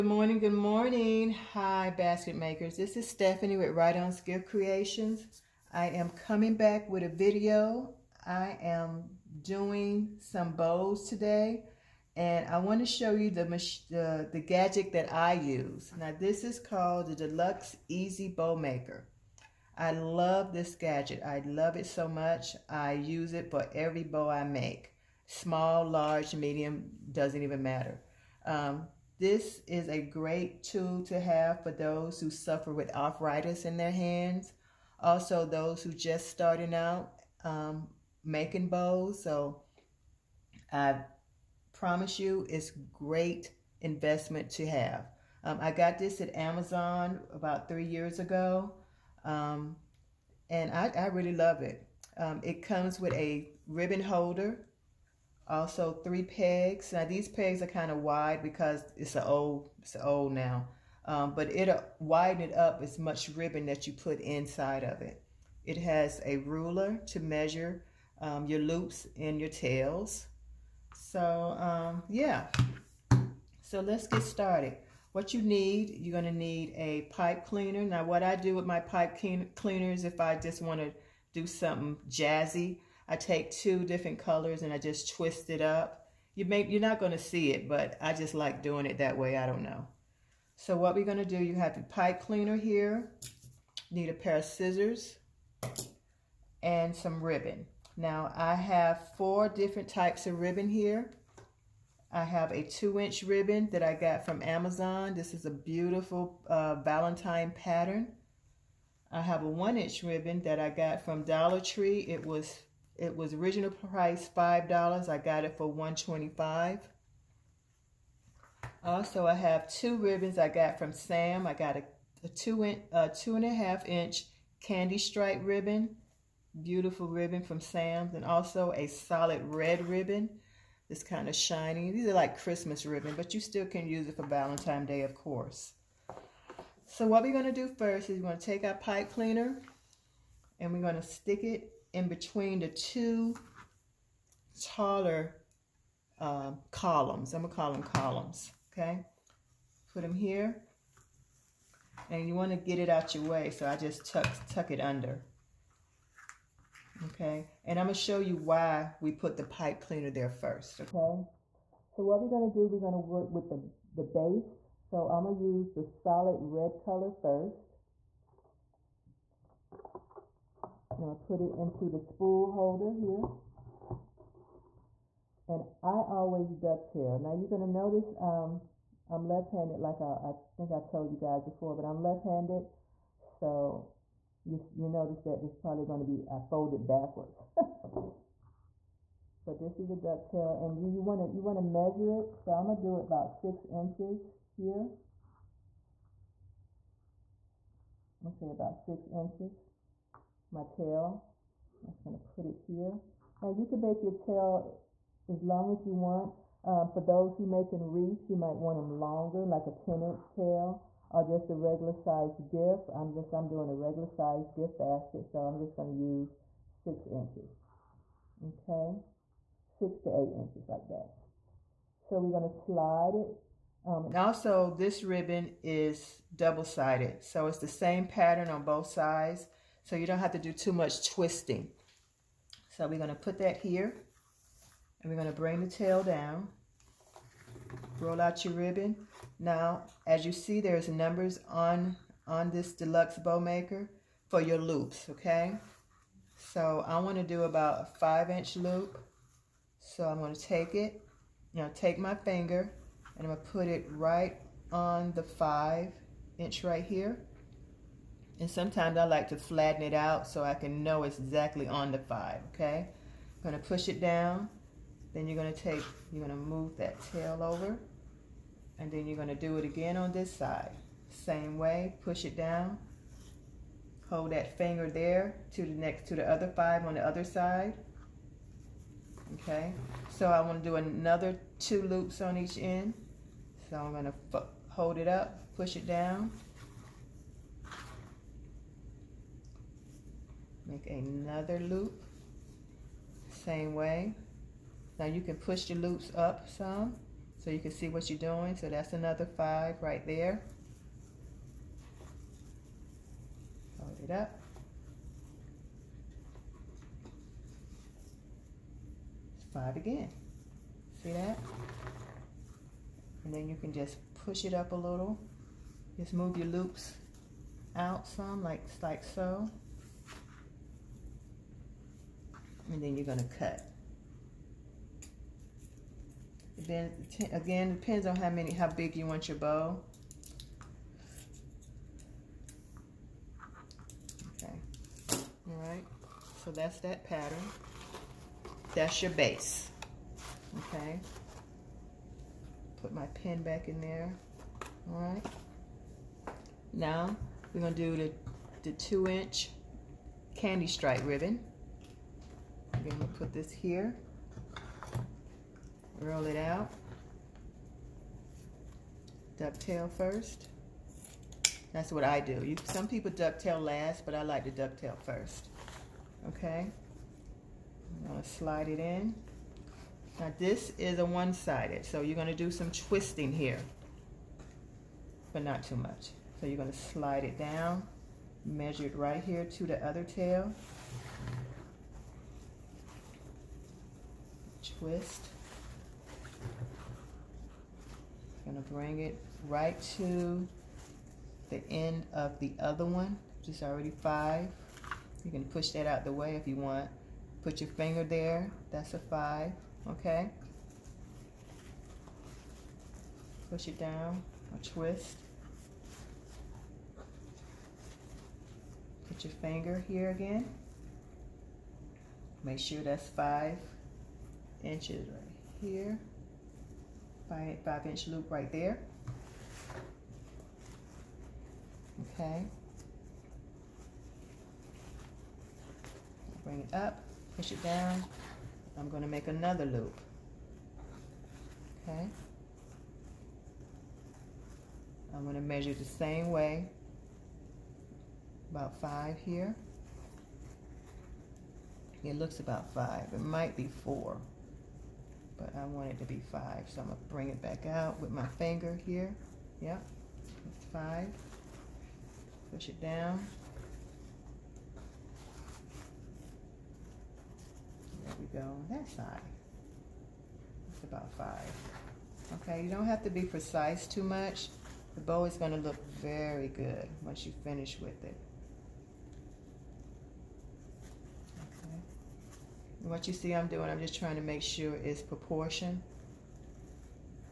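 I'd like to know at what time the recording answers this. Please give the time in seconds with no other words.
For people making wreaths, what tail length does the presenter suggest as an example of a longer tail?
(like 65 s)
209 s.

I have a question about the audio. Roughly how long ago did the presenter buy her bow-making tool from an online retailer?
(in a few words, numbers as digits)
3 years ago.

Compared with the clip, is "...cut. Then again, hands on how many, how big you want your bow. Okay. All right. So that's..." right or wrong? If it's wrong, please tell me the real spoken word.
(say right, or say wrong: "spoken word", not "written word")
wrong: "depends", not "hands".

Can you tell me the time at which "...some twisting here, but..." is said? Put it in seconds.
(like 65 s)
372 s.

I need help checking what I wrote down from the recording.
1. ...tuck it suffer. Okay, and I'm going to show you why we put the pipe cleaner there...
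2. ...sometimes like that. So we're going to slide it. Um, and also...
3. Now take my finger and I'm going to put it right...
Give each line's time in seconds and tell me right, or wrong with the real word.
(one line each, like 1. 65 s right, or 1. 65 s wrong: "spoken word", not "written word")
1. 154 s wrong: "under", not "suffer"
2. 220 s wrong: "inches", not "sometimes"
3. 251 s right.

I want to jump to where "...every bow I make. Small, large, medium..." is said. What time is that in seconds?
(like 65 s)
23 s.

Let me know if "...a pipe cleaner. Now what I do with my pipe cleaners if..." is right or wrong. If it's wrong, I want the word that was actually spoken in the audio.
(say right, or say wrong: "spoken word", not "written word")
right.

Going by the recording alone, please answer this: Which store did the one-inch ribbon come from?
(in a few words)
Dollar Tree.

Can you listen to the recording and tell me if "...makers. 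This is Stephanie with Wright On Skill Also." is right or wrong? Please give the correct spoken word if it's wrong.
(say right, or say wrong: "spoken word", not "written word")
wrong: "Creations", not "Also".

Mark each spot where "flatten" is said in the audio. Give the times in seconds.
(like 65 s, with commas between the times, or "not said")
259 s.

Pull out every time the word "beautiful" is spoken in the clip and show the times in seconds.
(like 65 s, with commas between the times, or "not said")
105 s, 126 s.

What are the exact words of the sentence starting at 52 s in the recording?
Um, it comes with a ribbon holder also three pegs.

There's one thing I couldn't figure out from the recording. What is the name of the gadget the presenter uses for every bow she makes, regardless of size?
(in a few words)
Deluxe EZ Bow Maker.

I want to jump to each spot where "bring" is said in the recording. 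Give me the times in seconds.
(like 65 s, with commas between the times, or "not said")
235 s, 388 s, 426 s, 447 s.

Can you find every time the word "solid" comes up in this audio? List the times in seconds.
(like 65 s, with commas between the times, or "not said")
128 s, 165 s.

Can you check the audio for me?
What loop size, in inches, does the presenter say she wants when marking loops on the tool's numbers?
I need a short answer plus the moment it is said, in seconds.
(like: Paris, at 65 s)
5 inches, at 248 s.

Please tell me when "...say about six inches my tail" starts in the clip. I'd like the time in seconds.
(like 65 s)
198 s.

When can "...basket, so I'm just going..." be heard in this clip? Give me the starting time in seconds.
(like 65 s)
214 s.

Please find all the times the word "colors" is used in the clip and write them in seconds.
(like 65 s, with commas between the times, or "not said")
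84 s, 166 s.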